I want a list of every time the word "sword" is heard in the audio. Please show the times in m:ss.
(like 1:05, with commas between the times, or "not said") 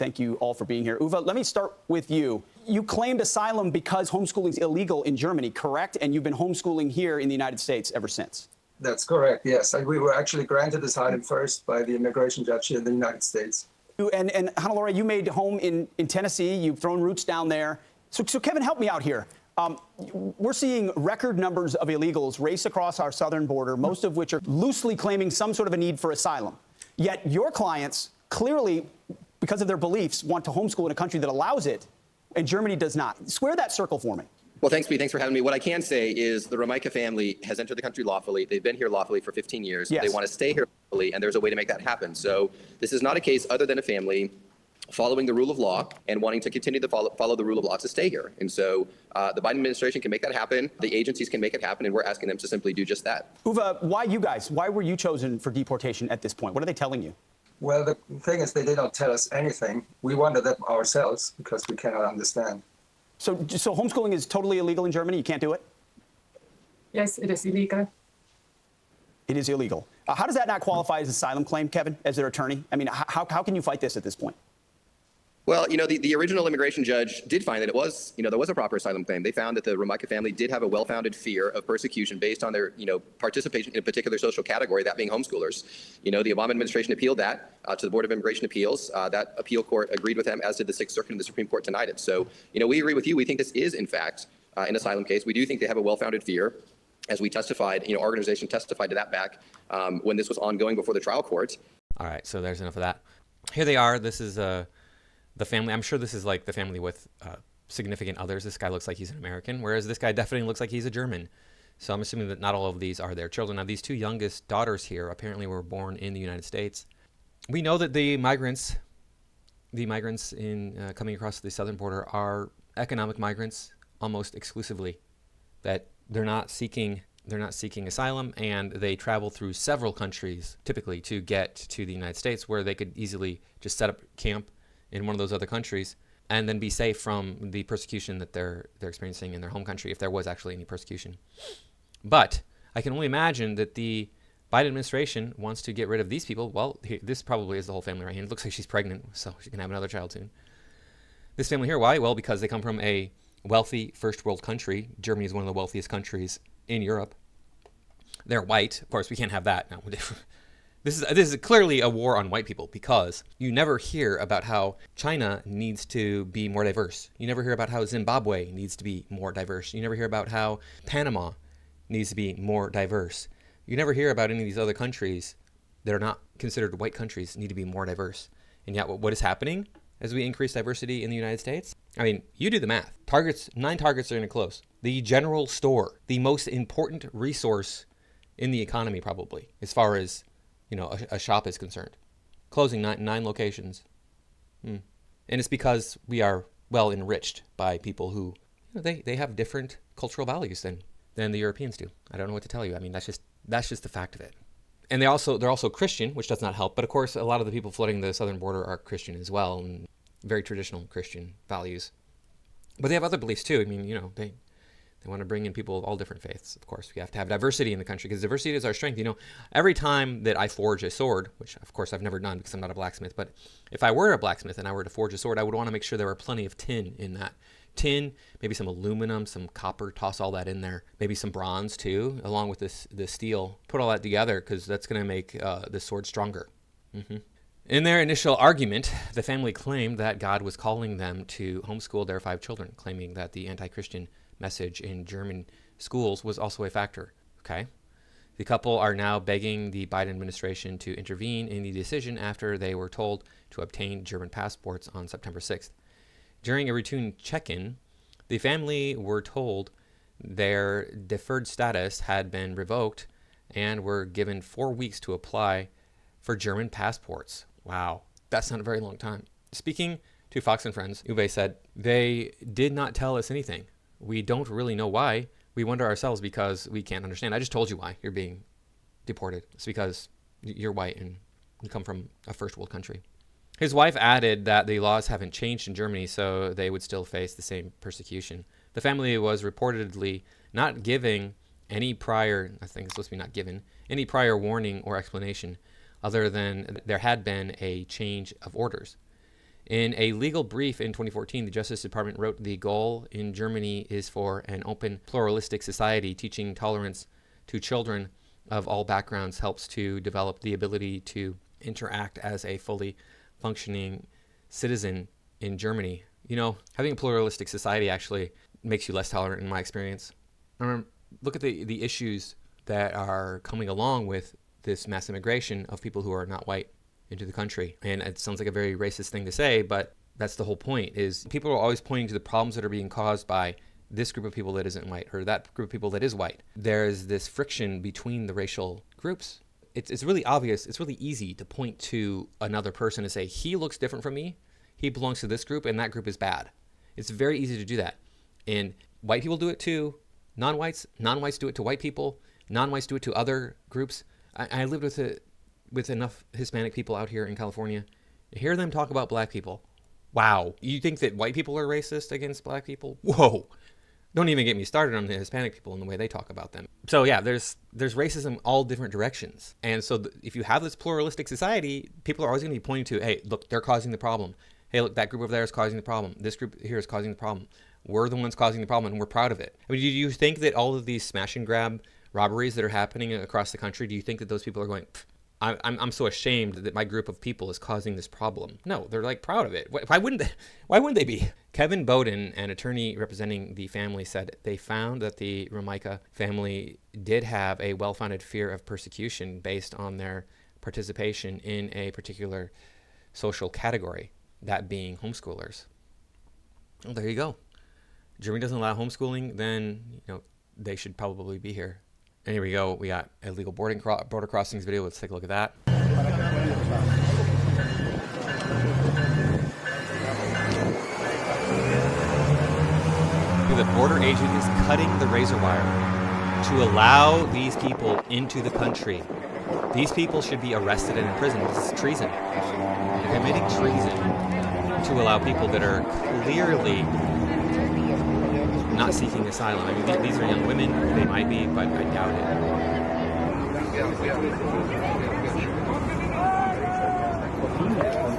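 3:40, 3:45, 3:55.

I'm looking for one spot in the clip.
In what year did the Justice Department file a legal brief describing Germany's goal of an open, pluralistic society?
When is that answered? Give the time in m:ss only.
5:00.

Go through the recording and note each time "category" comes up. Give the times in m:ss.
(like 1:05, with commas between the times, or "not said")
1:24, 6:43.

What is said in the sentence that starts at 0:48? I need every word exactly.
And so uh, the Biden administration can make that happen.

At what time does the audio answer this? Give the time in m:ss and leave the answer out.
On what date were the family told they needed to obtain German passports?
4:15.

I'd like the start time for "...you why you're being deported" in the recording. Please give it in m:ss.
4:37.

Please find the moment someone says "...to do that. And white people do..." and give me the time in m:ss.
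5:47.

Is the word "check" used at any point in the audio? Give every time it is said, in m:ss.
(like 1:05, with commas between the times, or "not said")
4:17.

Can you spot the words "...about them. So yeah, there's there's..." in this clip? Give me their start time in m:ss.
6:06.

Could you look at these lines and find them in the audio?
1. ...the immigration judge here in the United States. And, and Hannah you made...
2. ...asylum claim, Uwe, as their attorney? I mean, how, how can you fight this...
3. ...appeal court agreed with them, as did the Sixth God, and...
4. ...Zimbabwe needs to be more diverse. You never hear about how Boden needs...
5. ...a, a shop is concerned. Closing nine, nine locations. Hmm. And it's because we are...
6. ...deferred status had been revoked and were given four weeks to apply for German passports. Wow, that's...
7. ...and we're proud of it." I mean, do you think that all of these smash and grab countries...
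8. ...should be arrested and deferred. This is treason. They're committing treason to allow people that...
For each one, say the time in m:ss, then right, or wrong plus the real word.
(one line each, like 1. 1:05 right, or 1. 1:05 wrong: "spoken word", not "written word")
1. 0:11 right
2. 1:11 wrong: "Kevin", not "Uwe"
3. 1:29 wrong: "Circuit", not "God"
4. 2:47 wrong: "Panama", not "Boden"
5. 3:10 right
6. 4:20 right
7. 6:18 wrong: "robberies", not "countries"
8. 7:10 wrong: "imprisoned", not "deferred".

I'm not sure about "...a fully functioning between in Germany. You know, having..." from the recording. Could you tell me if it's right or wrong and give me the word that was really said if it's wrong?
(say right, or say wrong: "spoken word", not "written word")
wrong: "citizen", not "between".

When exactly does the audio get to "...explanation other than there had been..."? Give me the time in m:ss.
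4:54.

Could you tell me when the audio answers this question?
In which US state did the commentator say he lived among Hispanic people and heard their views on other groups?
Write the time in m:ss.
5:57.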